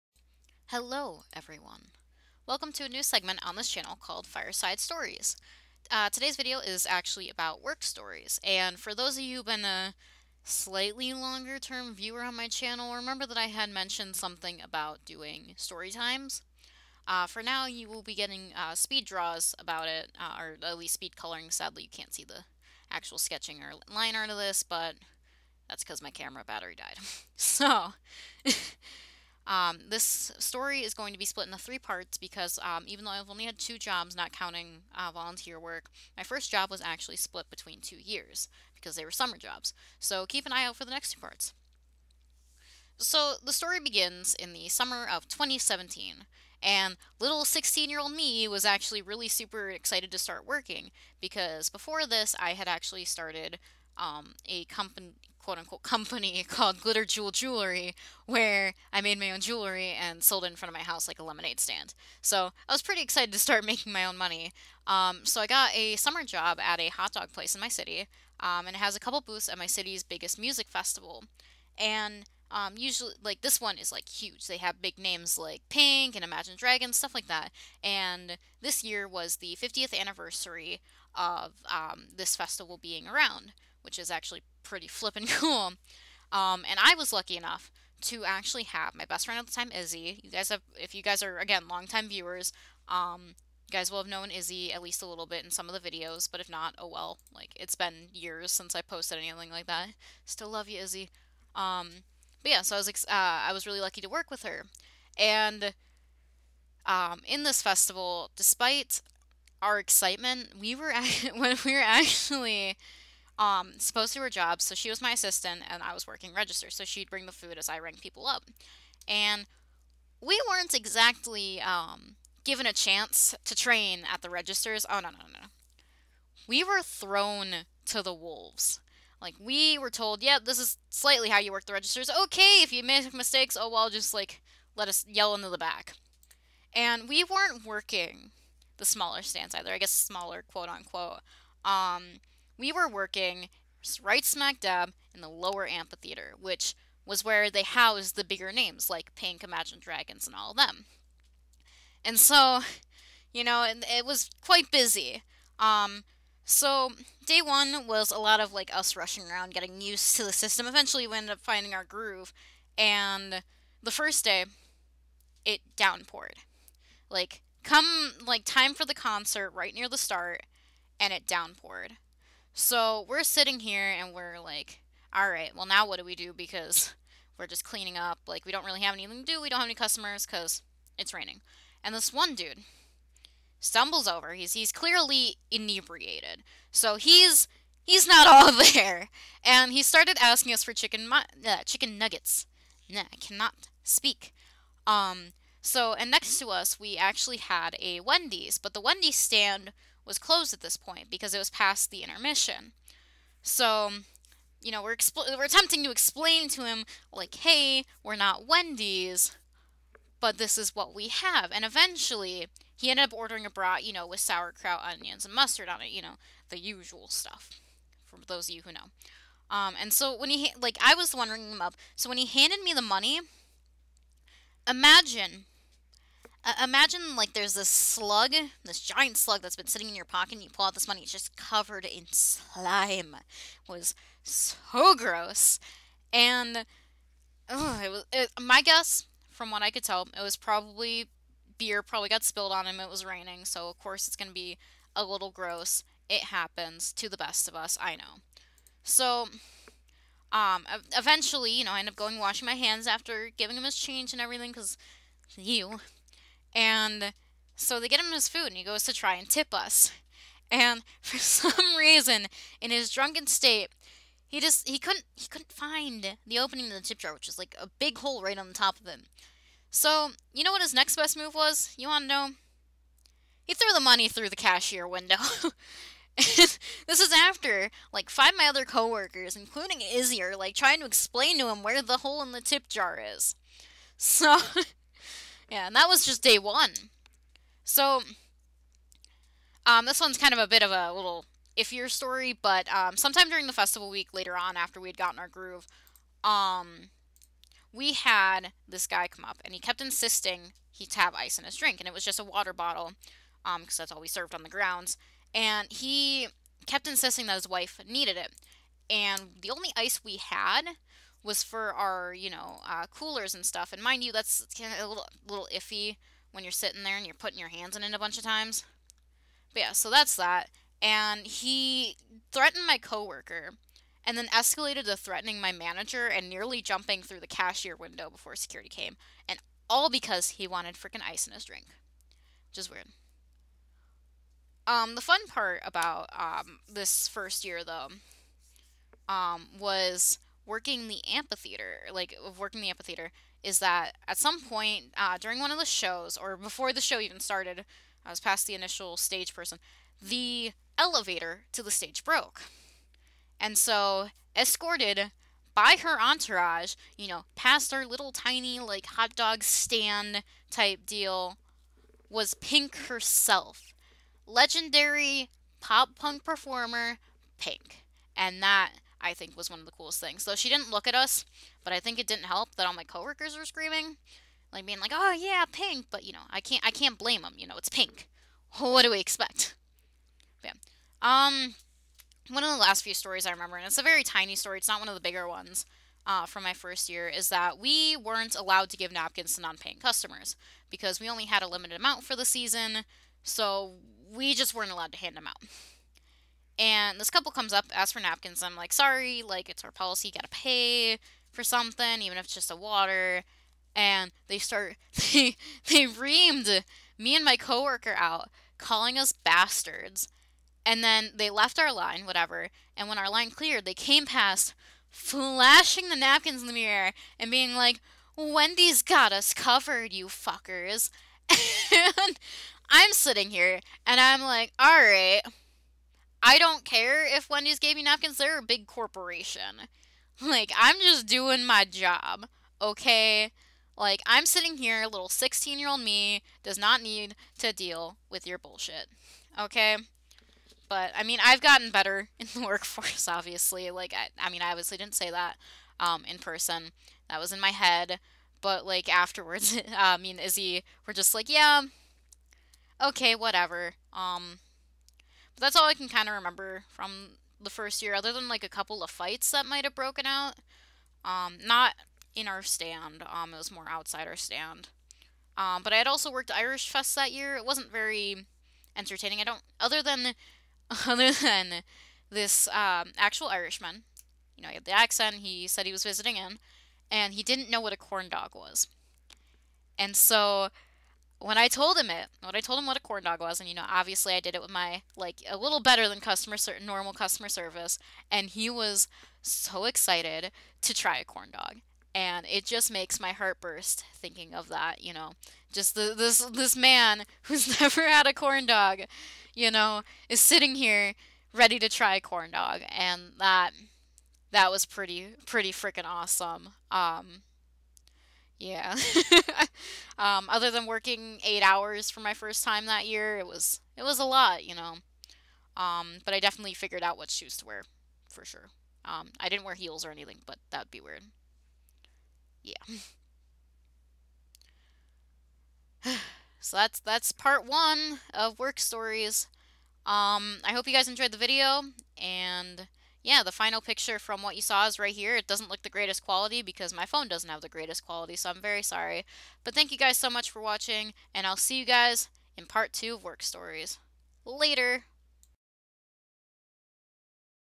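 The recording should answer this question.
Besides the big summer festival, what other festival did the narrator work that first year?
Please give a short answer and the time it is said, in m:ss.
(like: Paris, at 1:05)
Irish Fest, at 7:46.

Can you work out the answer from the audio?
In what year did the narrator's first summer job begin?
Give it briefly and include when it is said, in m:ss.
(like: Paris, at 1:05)
2017, at 0:45.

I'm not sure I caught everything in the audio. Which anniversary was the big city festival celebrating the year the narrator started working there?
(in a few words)
50th.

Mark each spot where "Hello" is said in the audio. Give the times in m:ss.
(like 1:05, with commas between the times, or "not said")
0:00.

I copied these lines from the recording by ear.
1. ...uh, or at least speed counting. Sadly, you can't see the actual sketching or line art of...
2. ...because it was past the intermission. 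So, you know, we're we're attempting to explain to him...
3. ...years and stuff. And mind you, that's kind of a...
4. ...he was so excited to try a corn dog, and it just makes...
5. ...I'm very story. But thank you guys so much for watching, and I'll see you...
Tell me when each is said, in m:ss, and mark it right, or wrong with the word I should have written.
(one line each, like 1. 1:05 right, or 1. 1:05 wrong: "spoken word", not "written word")
1. 0:20 wrong: "coloring", not "counting"
2. 3:21 right
3. 5:12 wrong: "coolers", not "years"
4. 8:08 right
5. 8:58 wrong: "sorry", not "story".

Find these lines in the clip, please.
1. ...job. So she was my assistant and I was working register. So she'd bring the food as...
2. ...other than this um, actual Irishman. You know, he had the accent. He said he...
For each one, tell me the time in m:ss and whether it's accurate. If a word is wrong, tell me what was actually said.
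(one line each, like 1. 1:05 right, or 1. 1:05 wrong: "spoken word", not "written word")
1. 1:54 right
2. 7:50 right.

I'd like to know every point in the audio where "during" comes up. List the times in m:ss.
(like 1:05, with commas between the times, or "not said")
4:53, 5:45.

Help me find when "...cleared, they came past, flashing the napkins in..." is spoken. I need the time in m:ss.
6:53.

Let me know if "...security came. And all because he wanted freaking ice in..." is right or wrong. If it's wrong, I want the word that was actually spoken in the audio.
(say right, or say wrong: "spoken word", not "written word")
right.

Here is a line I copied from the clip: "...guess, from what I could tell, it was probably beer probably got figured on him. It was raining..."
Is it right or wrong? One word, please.
wrong.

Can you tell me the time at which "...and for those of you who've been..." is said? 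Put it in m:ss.
0:08.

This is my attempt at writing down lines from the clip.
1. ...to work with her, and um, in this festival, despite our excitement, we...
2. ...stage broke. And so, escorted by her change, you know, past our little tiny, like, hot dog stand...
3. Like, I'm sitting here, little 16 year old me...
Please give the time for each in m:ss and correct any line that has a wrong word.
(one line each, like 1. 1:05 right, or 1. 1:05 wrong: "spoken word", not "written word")
1. 1:44 right
2. 5:51 wrong: "entourage", not "change"
3. 7:13 right.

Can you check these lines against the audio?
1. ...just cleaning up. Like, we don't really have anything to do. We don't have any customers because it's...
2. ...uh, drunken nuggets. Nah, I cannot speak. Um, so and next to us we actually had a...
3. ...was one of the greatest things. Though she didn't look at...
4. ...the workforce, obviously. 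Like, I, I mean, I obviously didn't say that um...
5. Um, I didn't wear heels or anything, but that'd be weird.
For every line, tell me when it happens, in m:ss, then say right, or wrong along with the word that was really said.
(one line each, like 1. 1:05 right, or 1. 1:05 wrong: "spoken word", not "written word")
1. 2:57 right
2. 3:11 wrong: "chicken", not "drunken"
3. 6:09 wrong: "coolest", not "greatest"
4. 7:22 right
5. 8:38 right.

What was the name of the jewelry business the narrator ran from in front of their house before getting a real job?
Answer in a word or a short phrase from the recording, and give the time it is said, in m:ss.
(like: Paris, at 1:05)
Glitter Jewel Jewelry, at 0:56.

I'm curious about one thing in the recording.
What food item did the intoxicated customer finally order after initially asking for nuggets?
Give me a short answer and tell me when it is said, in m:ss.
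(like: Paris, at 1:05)
A brat, at 3:33.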